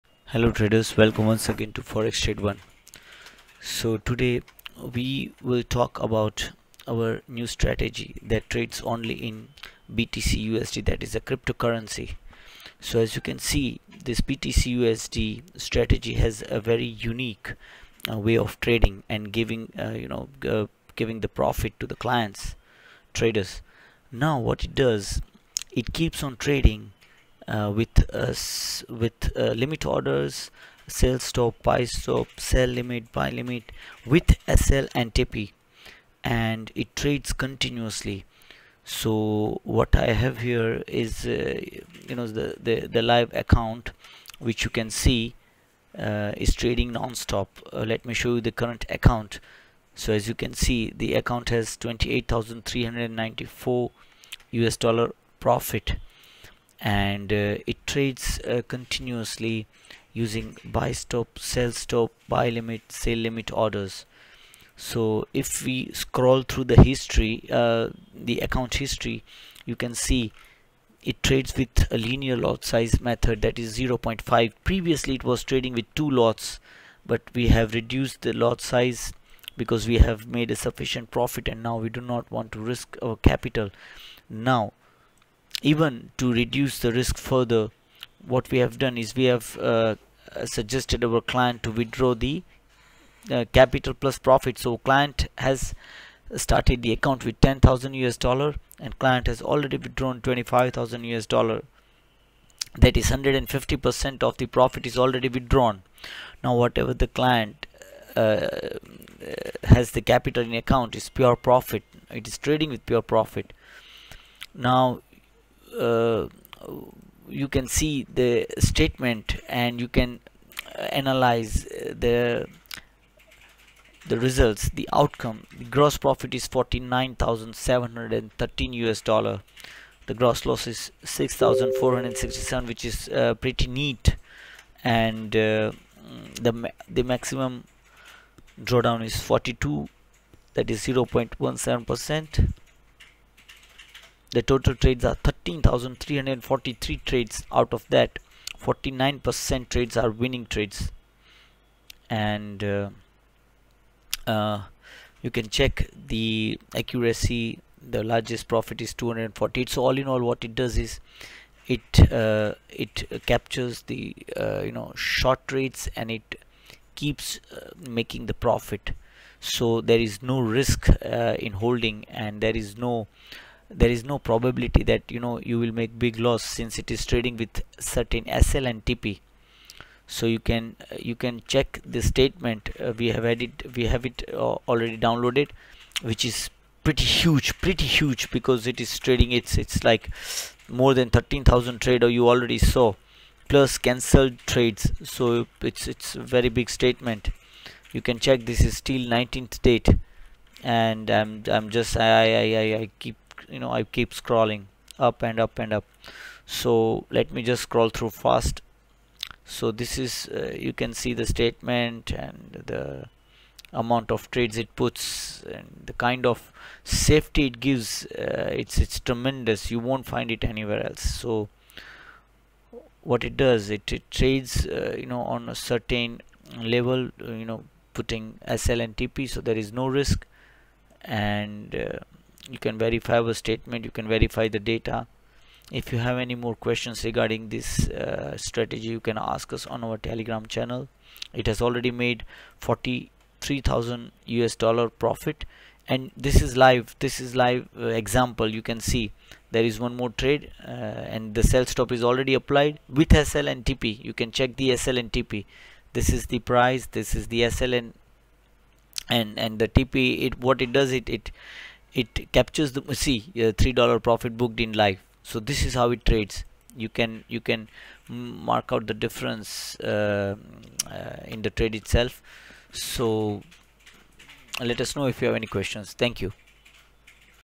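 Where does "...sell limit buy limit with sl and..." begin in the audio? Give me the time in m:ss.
0:32.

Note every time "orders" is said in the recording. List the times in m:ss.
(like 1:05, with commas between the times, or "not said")
0:29, 1:03.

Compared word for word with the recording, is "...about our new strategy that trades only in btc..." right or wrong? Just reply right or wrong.
right.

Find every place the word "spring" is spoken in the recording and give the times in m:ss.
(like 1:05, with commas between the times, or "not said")
not said.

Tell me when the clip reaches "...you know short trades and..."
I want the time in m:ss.
2:44.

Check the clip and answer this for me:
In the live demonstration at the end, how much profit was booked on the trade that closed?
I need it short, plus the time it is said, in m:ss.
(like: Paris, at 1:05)
3 dollars, at 4:23.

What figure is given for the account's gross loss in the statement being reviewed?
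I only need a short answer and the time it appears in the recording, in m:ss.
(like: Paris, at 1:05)
6,467, at 2:11.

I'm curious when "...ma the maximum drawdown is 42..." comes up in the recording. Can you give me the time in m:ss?
2:16.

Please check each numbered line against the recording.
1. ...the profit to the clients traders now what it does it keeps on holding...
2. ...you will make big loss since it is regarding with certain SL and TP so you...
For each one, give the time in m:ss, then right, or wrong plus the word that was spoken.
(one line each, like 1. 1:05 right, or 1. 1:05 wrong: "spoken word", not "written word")
1. 0:21 wrong: "trading", not "holding"
2. 2:55 wrong: "trading", not "regarding".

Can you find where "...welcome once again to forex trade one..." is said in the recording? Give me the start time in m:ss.
0:00.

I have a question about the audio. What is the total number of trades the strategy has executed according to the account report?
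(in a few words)
13,343.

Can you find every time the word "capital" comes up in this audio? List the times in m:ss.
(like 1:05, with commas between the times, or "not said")
1:23, 1:33, 1:50.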